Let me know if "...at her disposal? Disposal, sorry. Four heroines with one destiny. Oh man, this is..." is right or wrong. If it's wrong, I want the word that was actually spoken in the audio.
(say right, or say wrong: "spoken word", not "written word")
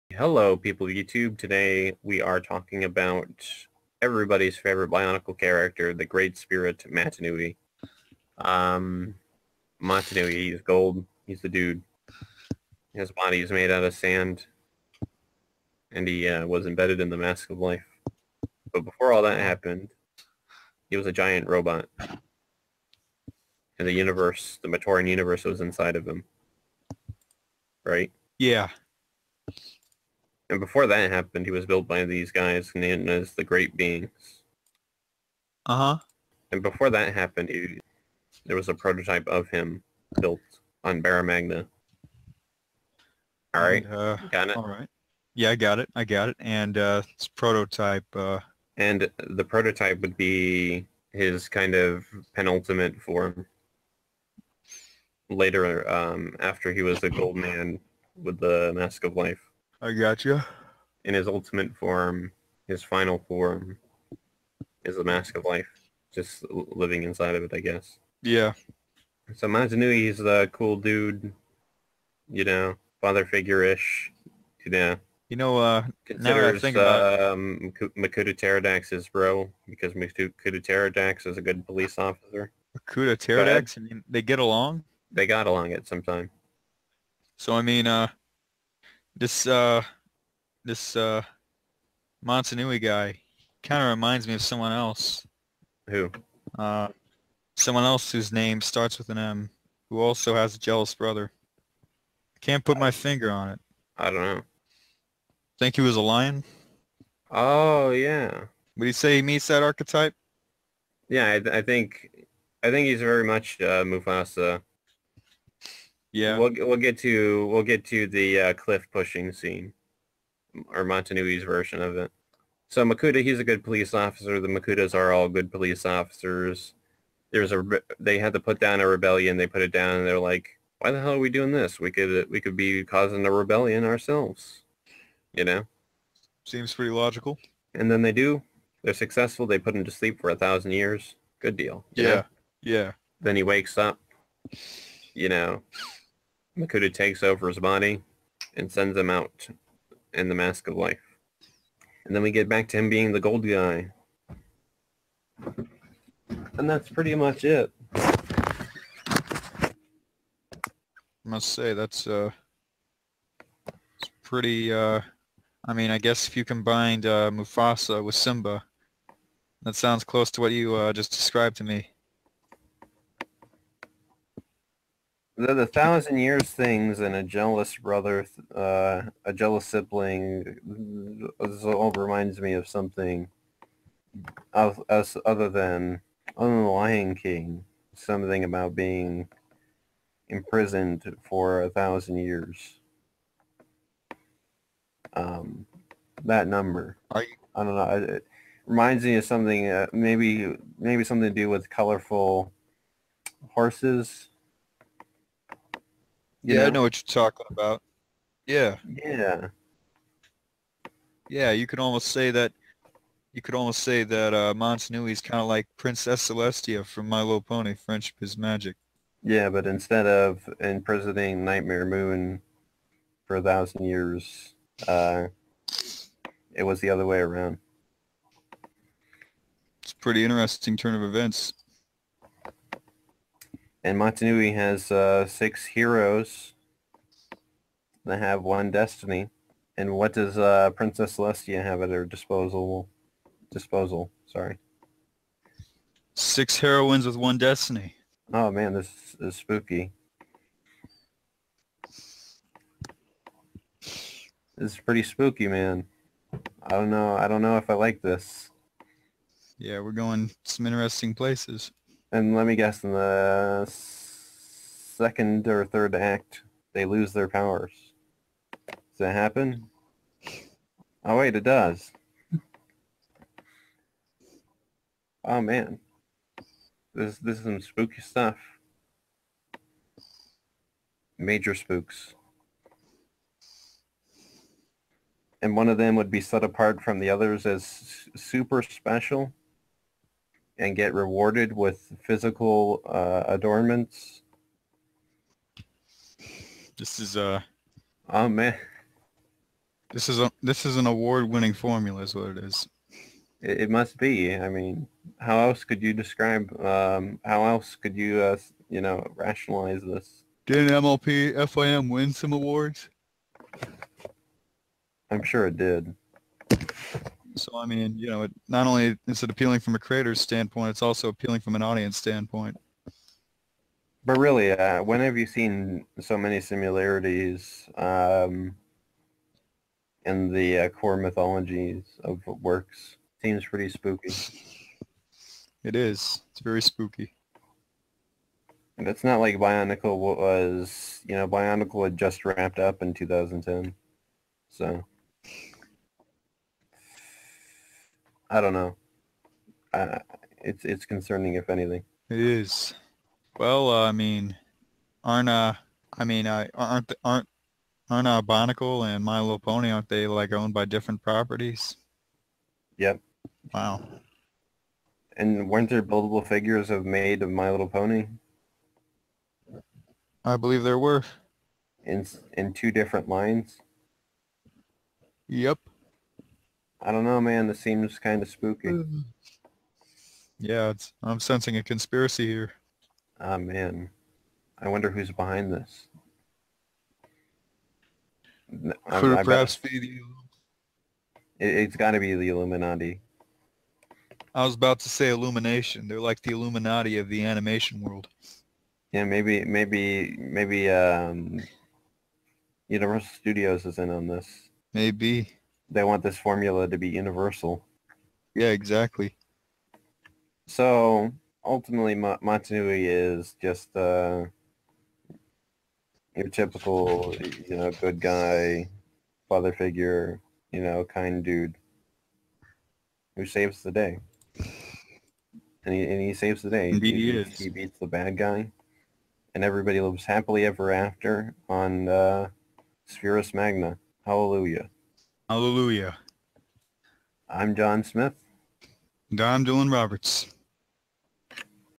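wrong: "Six", not "Four".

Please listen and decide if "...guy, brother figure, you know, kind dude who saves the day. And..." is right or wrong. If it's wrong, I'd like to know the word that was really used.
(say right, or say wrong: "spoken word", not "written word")
wrong: "father", not "brother".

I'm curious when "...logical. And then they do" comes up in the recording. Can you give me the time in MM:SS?
02:16.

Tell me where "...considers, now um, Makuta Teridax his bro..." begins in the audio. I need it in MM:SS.
01:16.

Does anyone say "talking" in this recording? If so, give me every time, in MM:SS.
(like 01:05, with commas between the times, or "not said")
00:02, 03:27.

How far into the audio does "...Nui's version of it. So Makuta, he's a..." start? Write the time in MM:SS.
02:01.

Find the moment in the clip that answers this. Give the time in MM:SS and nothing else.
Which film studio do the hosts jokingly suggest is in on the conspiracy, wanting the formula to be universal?
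06:42.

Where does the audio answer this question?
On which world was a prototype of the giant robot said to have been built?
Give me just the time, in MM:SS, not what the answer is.
00:41.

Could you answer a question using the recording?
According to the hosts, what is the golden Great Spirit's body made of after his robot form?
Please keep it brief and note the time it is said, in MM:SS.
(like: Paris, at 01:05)
Sand, at 00:13.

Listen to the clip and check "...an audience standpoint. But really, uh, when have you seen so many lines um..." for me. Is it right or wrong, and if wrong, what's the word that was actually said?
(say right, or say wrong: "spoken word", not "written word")
wrong: "similarities", not "lines".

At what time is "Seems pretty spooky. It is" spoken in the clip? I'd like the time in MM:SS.
05:33.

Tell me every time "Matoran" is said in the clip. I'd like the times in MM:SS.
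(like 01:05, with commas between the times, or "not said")
00:24.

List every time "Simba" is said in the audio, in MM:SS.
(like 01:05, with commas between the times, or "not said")
02:48.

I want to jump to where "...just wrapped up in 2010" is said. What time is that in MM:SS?
05:41.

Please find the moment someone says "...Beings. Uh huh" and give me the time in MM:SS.
00:33.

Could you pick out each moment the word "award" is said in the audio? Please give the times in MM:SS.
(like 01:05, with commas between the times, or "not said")
05:00, 05:12.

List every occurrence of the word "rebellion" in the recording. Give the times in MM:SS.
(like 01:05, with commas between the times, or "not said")
02:08, 02:13.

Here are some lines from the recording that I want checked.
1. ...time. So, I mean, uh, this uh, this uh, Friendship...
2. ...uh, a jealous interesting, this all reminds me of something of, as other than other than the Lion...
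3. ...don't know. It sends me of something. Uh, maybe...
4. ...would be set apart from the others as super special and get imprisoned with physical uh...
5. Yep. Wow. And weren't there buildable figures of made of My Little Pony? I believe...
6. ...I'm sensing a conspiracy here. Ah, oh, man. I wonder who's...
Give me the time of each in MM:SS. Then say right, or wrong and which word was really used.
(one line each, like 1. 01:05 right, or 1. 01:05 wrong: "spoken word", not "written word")
1. 01:26 wrong: "Mata", not "Friendship"
2. 02:58 wrong: "sibling", not "interesting"
3. 03:17 wrong: "reminds", not "sends"
4. 04:45 wrong: "rewarded", not "imprisoned"
5. 06:02 right
6. 06:21 right.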